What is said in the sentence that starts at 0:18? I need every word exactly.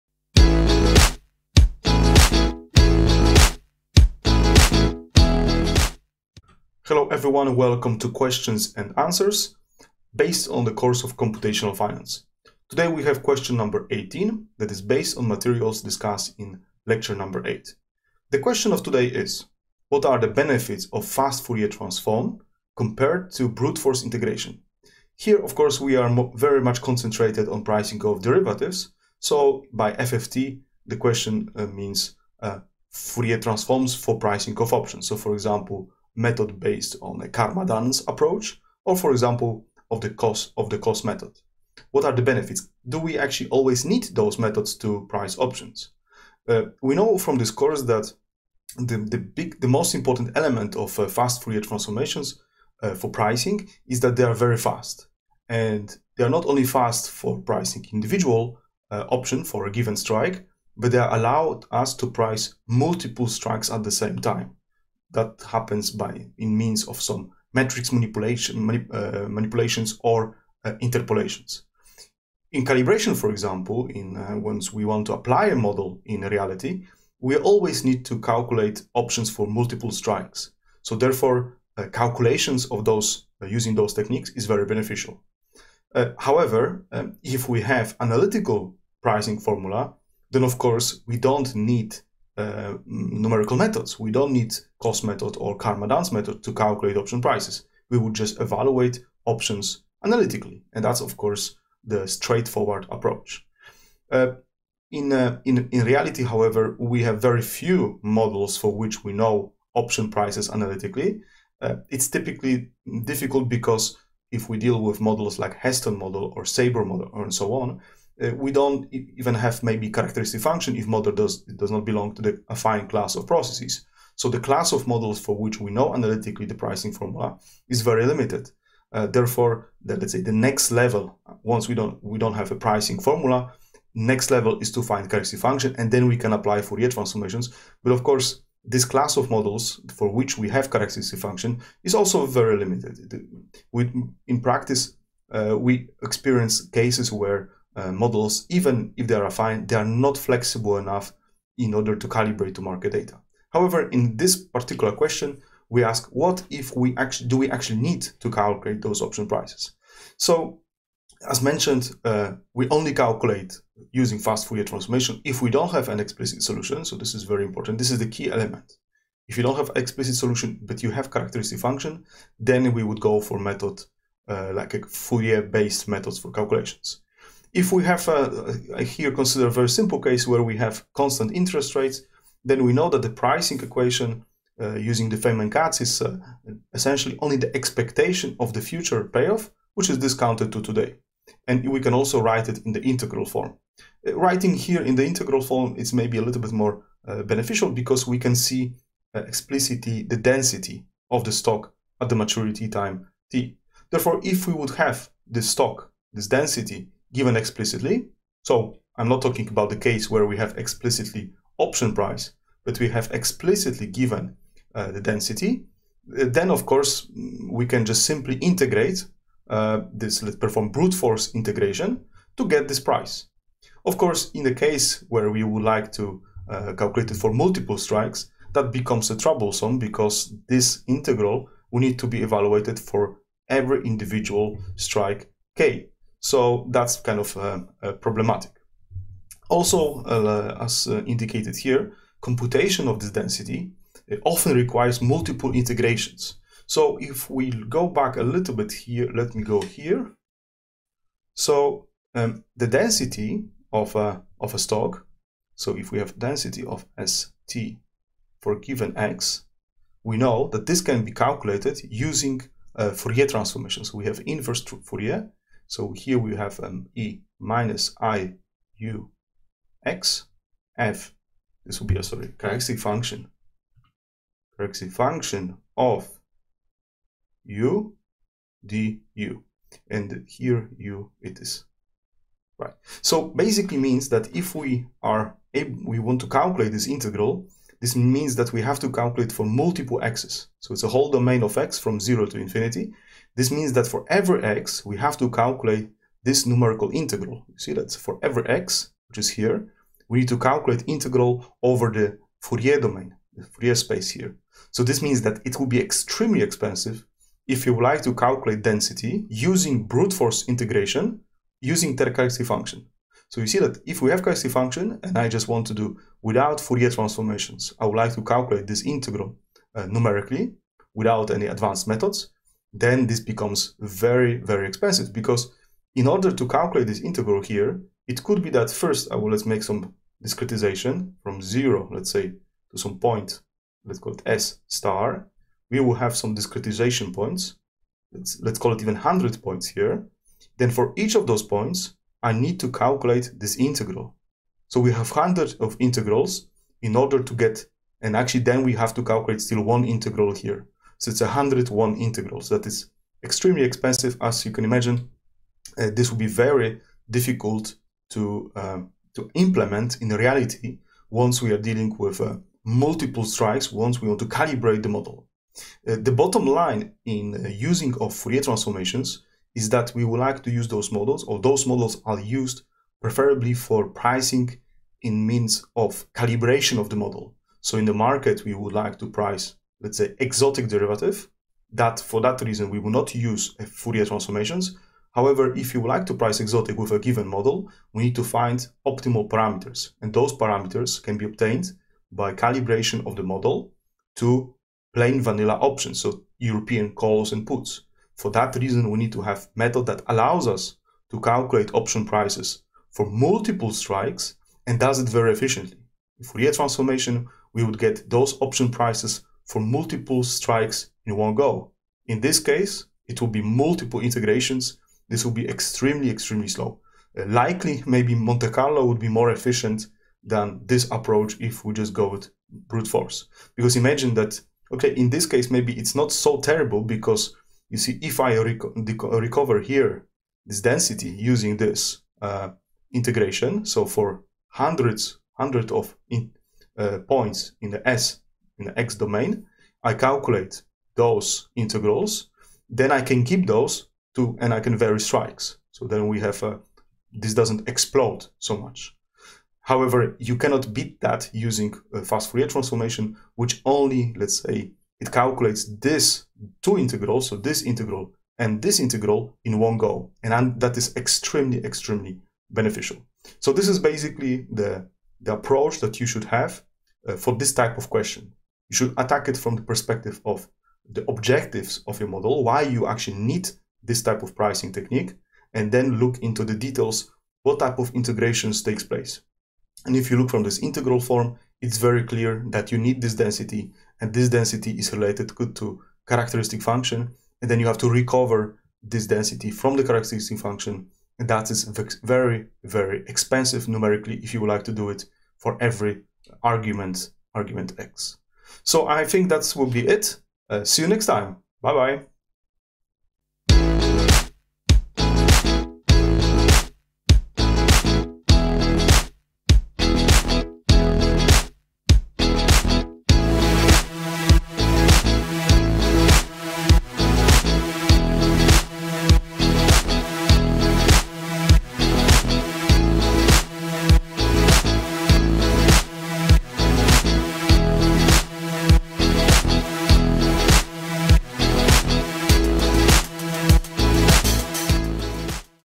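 The question of today is, what are the benefits of fast Fourier transform compared to brute force integration?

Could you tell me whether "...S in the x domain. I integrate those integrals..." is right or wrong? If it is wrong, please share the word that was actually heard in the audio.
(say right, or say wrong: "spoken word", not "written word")
wrong: "calculate", not "integrate".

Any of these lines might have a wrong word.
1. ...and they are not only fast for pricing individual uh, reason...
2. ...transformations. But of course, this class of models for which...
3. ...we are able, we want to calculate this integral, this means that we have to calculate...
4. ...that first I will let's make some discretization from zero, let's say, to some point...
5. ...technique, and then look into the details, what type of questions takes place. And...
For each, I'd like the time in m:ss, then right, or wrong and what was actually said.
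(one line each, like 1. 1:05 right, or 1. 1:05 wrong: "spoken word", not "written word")
1. 0:55 wrong: "option", not "reason"
2. 2:16 right
3. 4:44 right
4. 5:28 right
5. 7:54 wrong: "integrations", not "questions".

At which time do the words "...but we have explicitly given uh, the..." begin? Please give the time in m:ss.
3:32.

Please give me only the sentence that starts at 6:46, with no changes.
Fourier transformation, we would get those option prices for multiple strikes in one go.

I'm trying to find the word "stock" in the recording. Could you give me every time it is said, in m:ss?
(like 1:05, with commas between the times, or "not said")
3:21, 3:25, 4:14.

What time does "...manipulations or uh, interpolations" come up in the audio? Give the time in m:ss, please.
1:09.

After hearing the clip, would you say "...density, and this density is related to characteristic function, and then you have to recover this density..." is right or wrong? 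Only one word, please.
right.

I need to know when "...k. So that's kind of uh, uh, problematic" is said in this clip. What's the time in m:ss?
3:55.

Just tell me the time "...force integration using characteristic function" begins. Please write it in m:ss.
5:10.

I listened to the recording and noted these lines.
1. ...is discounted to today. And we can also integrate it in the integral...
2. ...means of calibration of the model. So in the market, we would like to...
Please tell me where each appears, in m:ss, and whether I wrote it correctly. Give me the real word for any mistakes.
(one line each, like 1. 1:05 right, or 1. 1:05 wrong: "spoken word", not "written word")
1. 3:09 wrong: "write", not "integrate"
2. 6:15 right.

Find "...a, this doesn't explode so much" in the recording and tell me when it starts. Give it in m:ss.
7:26.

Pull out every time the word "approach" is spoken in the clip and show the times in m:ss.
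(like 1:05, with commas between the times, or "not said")
0:38, 1:42, 7:00, 7:45.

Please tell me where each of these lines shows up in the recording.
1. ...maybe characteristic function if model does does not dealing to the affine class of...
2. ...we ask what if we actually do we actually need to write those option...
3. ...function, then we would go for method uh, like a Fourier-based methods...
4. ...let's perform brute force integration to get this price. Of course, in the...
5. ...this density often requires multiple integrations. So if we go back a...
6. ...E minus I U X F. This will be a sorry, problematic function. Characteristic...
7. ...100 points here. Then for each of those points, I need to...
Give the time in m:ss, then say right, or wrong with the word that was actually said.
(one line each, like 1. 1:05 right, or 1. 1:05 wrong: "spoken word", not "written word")
1. 1:59 wrong: "belong", not "dealing"
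2. 2:35 wrong: "calculate", not "write"
3. 2:51 right
4. 3:40 right
5. 4:02 right
6. 4:26 wrong: "characteristic", not "problematic"
7. 5:38 right.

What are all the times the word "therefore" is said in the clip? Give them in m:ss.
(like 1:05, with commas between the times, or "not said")
1:20, 2:09, 3:23.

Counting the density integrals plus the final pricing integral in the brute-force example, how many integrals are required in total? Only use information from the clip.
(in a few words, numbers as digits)
101.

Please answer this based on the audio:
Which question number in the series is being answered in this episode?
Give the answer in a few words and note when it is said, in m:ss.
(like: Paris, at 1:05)
18, at 0:13.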